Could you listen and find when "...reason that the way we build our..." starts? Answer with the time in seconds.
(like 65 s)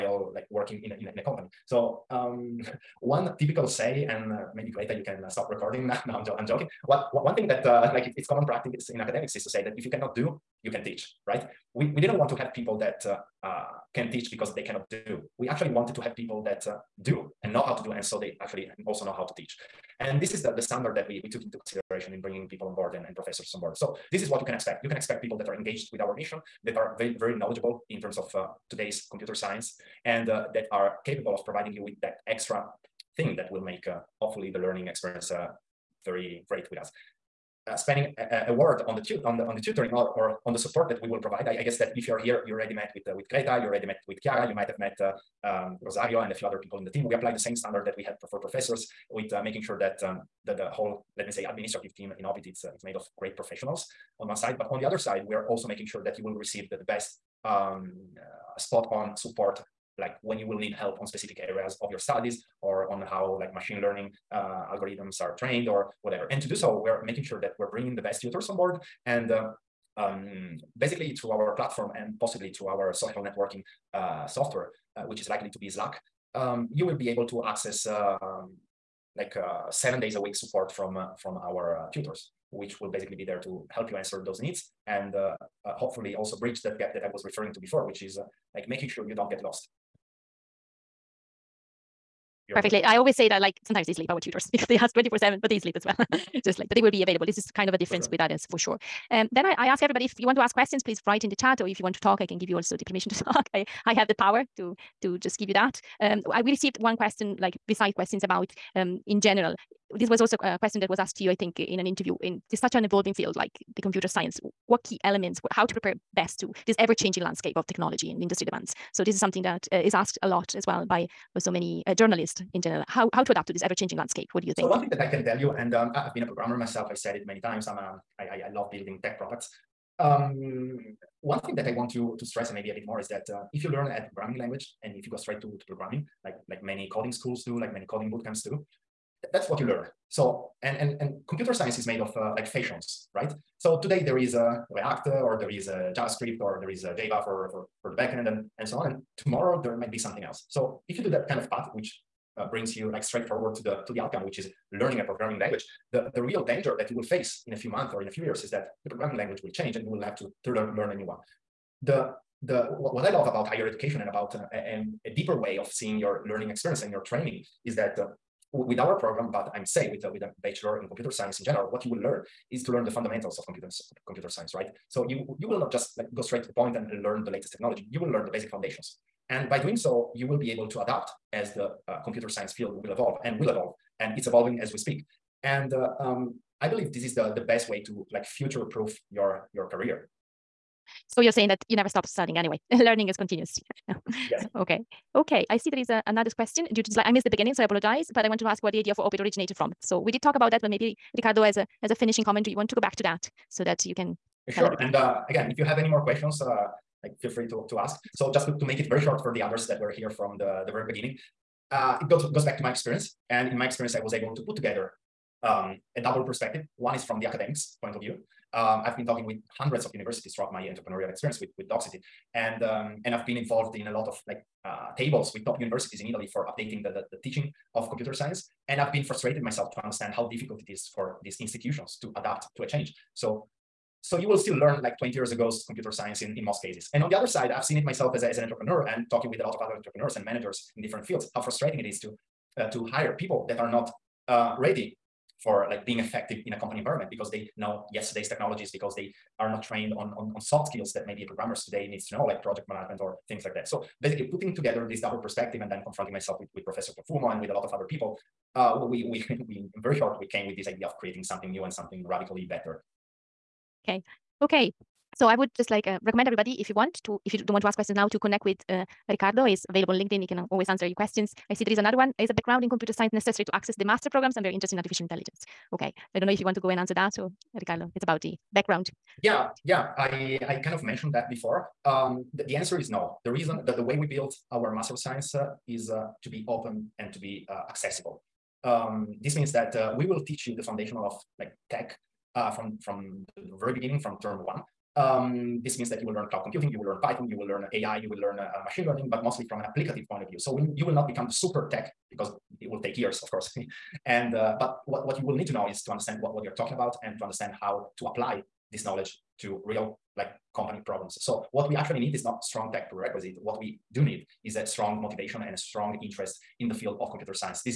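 283 s.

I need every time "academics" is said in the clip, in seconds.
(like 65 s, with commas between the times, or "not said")
8 s, 217 s.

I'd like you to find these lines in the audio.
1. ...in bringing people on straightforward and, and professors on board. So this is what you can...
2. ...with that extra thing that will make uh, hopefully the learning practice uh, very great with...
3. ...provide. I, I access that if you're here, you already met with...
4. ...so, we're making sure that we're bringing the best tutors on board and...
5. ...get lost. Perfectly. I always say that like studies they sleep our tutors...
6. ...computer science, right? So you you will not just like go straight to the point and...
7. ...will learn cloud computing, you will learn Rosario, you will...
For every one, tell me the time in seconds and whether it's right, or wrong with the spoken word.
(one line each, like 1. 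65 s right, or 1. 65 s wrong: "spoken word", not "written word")
1. 22 s wrong: "board", not "straightforward"
2. 31 s wrong: "experience", not "practice"
3. 41 s wrong: "guess", not "access"
4. 66 s right
5. 89 s wrong: "sometimes", not "studies"
6. 174 s right
7. 296 s wrong: "Python", not "Rosario".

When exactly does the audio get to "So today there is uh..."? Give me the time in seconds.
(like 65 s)
143 s.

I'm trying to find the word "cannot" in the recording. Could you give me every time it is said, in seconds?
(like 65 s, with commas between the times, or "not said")
9 s, 14 s.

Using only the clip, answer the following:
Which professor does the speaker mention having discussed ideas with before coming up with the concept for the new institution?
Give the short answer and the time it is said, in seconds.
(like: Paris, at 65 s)
Profumo, at 256 s.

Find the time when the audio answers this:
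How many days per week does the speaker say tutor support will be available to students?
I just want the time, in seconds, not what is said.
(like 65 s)
79 s.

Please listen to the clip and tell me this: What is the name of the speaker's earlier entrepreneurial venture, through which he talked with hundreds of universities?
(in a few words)
Docsity.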